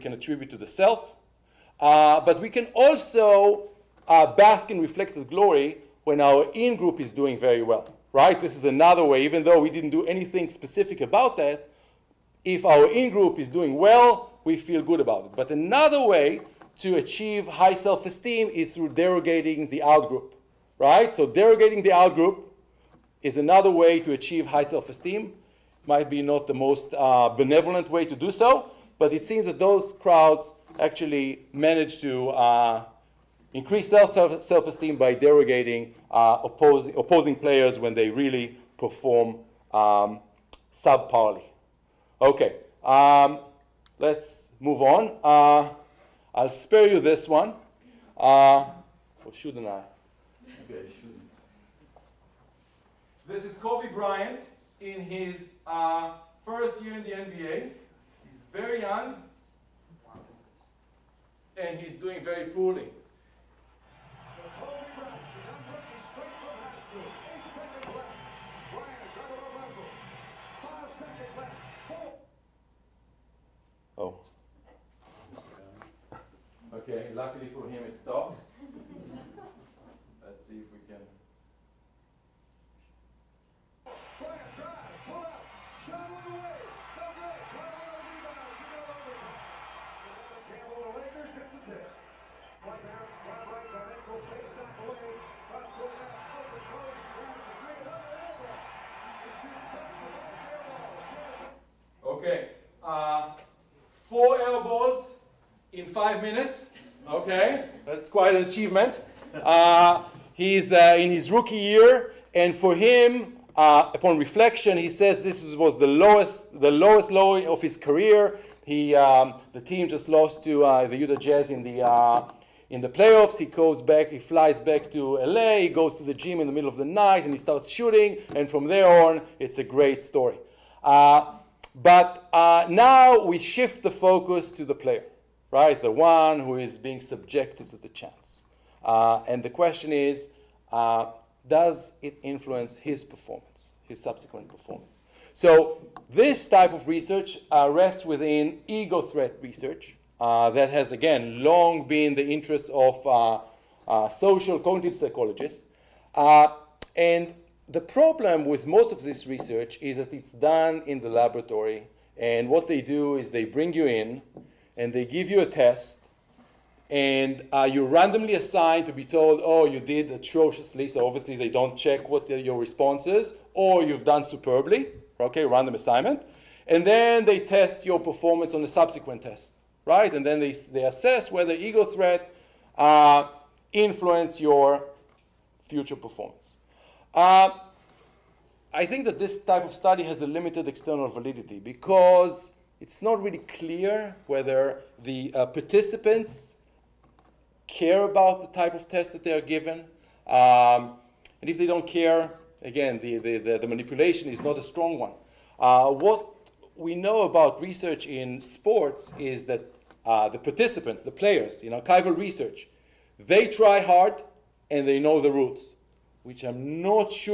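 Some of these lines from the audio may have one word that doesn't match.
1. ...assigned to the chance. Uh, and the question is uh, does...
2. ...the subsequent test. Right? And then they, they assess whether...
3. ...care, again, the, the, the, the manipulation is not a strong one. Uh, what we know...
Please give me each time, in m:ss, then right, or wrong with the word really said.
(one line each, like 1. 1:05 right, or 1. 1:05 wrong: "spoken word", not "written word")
1. 2:17 wrong: "subjected", not "assigned"
2. 2:58 right
3. 3:21 right.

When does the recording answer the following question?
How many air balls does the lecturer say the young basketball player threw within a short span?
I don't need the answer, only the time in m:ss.
1:44.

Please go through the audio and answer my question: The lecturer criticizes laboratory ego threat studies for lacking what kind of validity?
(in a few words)
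External validity.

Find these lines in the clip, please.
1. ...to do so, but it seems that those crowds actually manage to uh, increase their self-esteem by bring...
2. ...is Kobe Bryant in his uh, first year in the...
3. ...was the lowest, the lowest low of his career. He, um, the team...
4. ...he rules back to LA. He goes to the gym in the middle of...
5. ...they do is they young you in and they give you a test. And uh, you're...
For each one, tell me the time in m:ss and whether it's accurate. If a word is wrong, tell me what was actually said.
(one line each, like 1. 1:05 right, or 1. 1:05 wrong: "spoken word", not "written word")
1. 0:28 wrong: "derogating", not "bring"
2. 0:53 right
3. 1:55 right
4. 2:04 wrong: "flies", not "rules"
5. 2:42 wrong: "bring", not "young".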